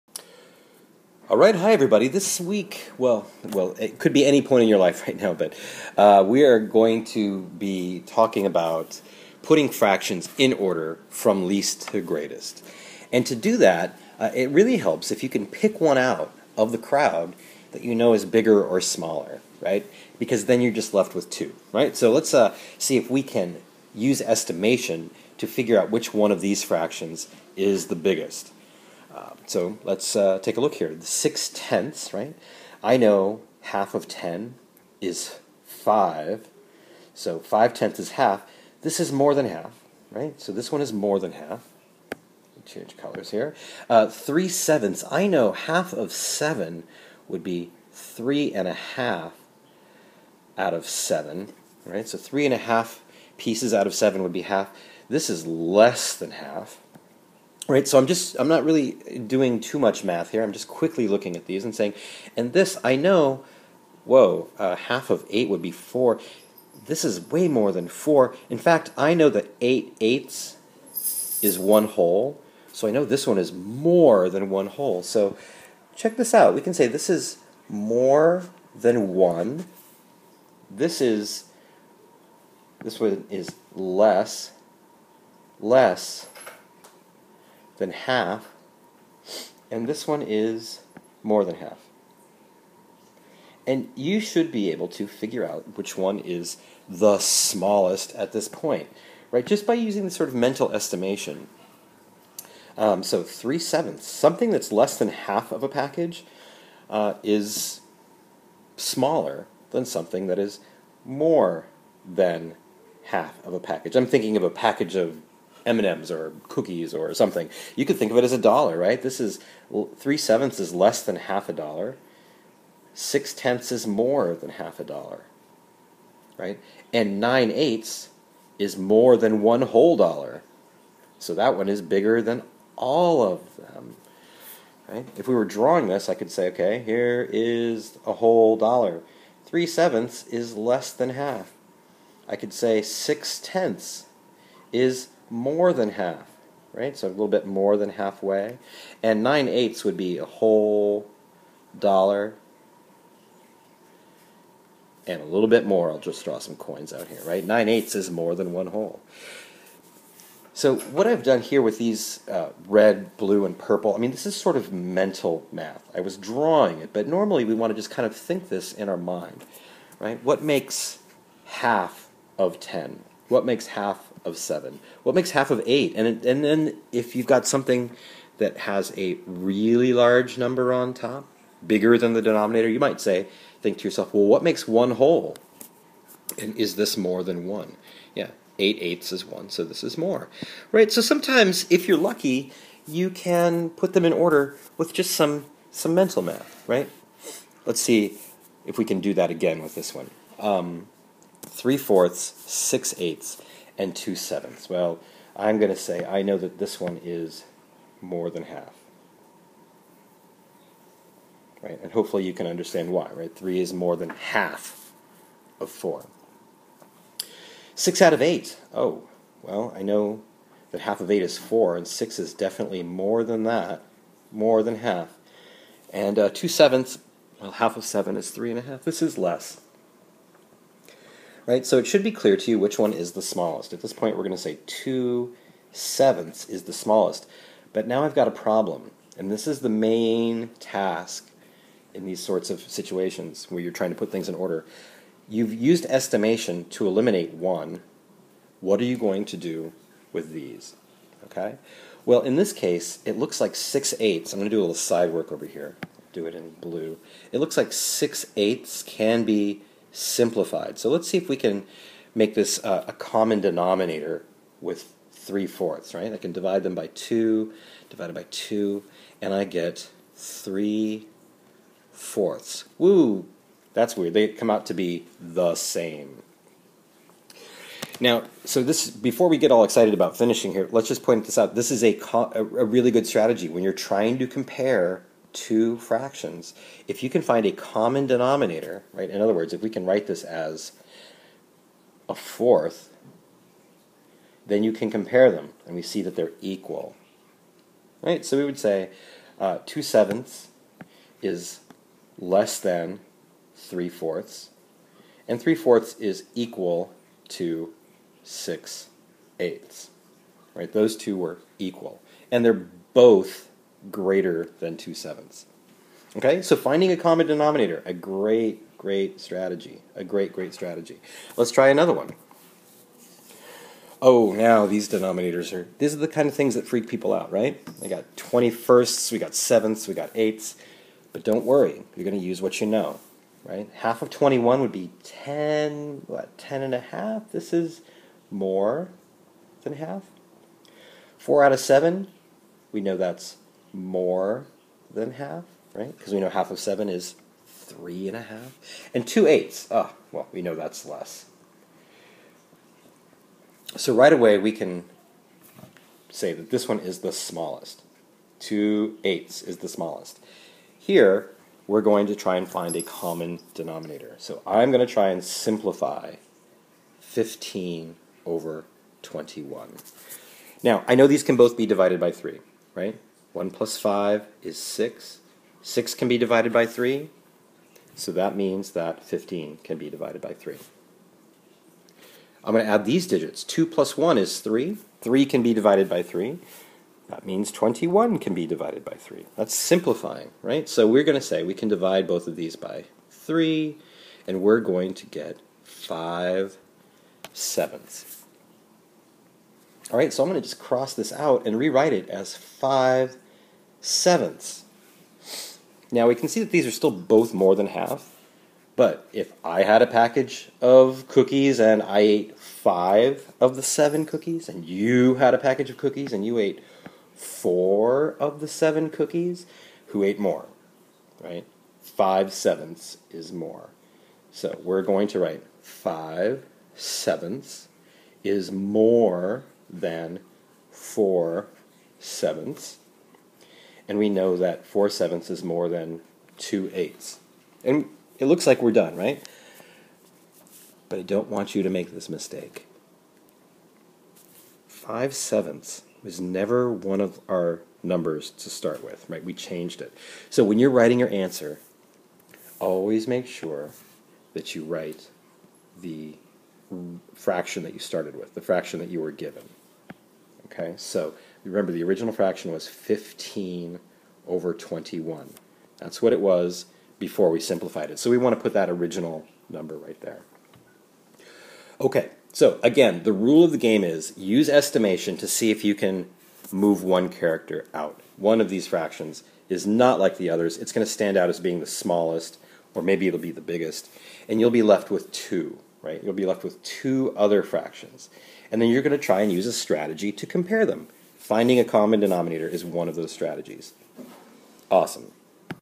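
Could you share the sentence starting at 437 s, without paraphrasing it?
And it looks like we're done, right?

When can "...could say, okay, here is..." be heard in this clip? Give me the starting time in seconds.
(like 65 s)
136 s.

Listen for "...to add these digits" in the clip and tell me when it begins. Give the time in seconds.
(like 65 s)
382 s.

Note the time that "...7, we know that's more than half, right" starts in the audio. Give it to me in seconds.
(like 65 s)
341 s.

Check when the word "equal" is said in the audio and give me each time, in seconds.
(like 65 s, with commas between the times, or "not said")
296 s, 306 s, 311 s.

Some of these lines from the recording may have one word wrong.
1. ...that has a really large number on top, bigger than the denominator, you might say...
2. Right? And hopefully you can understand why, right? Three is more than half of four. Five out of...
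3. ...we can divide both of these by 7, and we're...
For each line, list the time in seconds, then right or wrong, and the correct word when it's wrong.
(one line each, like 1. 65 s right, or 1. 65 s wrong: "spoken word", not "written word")
1. 178 s right
2. 211 s wrong: "Six", not "Five"
3. 391 s wrong: "3", not "7".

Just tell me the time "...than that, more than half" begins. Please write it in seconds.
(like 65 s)
223 s.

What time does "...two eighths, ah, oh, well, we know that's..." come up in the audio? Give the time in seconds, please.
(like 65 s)
349 s.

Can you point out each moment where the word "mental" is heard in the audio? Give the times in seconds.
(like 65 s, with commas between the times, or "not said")
100 s, 164 s, 195 s.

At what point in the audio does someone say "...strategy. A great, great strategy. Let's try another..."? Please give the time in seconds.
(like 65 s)
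319 s.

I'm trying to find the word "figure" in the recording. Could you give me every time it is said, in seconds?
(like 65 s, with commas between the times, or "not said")
25 s, 95 s.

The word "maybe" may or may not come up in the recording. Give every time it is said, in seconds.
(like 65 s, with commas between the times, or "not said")
482 s.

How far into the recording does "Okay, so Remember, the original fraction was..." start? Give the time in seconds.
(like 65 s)
460 s.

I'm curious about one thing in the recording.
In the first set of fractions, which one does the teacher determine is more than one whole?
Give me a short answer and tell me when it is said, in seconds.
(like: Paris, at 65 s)
9/8, at 127 s.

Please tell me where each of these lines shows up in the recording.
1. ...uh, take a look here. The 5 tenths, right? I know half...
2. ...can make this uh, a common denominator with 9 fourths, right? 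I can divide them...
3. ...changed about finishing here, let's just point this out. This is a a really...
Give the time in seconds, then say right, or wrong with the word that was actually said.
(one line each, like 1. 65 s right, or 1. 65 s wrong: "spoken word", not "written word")
1. 30 s wrong: "6", not "5"
2. 261 s wrong: "3", not "9"
3. 279 s wrong: "excited", not "changed".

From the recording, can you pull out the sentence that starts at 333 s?
Half of 21 would be 10, what, 10 and a half?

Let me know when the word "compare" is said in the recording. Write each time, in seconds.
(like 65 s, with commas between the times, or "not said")
284 s, 294 s, 490 s.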